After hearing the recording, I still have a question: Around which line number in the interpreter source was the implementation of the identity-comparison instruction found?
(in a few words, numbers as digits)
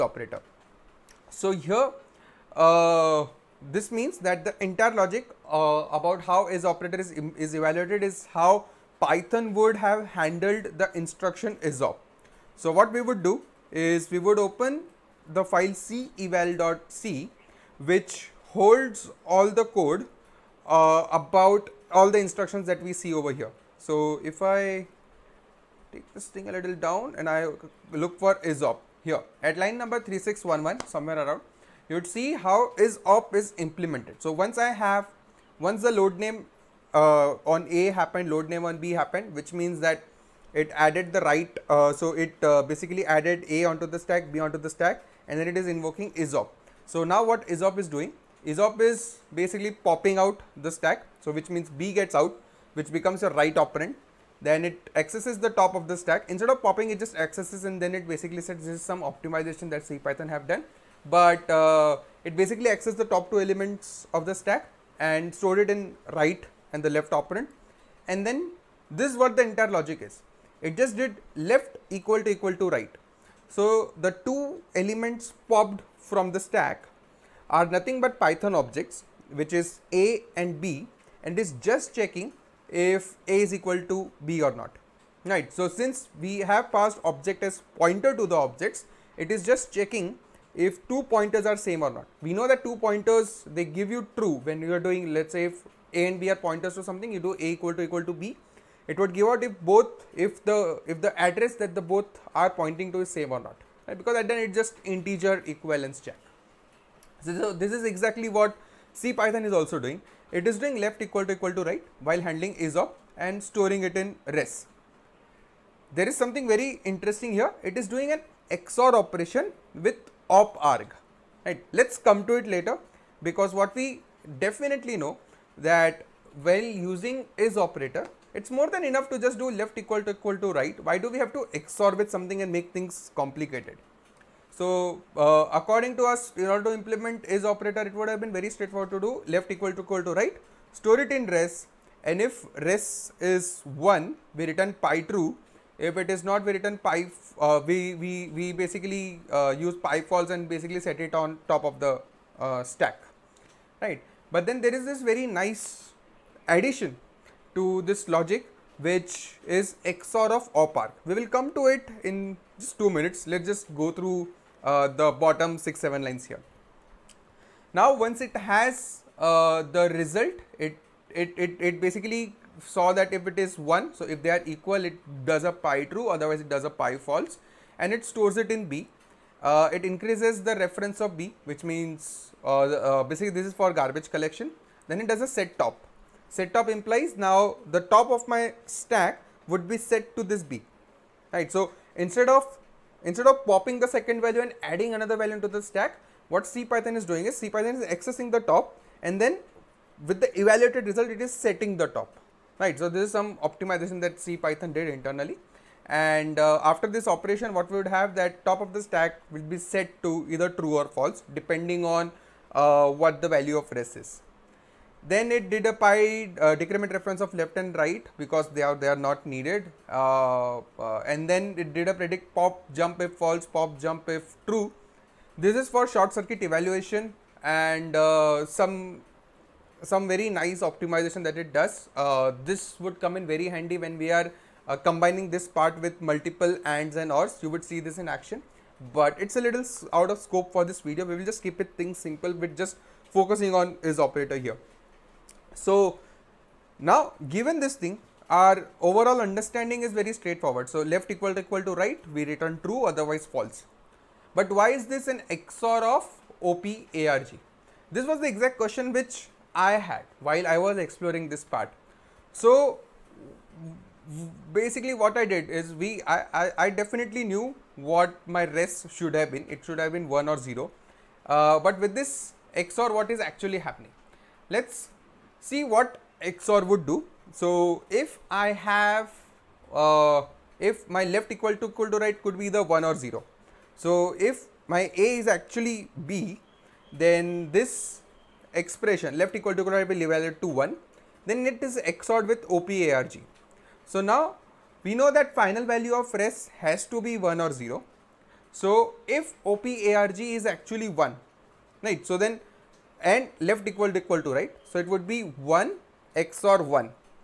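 3611.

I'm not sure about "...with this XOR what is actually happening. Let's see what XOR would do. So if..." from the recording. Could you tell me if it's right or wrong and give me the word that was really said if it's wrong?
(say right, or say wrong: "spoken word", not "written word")
right.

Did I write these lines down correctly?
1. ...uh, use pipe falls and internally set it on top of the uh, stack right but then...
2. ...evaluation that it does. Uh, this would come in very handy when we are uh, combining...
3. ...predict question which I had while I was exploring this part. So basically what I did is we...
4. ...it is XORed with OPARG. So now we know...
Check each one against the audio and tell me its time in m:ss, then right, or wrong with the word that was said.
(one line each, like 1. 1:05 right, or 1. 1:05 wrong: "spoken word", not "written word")
1. 2:29 wrong: "basically", not "internally"
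2. 3:50 wrong: "optimization", not "evaluation"
3. 4:18 wrong: "exact", not "predict"
4. 4:51 right.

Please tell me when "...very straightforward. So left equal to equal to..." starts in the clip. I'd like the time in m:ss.
4:09.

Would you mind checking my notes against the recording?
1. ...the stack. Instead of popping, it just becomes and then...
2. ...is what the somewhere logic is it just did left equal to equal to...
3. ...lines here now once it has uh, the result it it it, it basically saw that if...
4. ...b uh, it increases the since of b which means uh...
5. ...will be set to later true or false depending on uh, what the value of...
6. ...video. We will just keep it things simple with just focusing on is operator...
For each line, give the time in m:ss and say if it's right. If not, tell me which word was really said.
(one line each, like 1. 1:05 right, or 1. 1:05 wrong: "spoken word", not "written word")
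1. 0:55 wrong: "accesses", not "becomes"
2. 1:09 wrong: "entire", not "somewhere"
3. 2:46 right
4. 2:58 wrong: "reference", not "since"
5. 3:29 wrong: "either", not "later"
6. 4:00 right.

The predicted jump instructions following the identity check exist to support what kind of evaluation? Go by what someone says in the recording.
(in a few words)
short circuit evaluation.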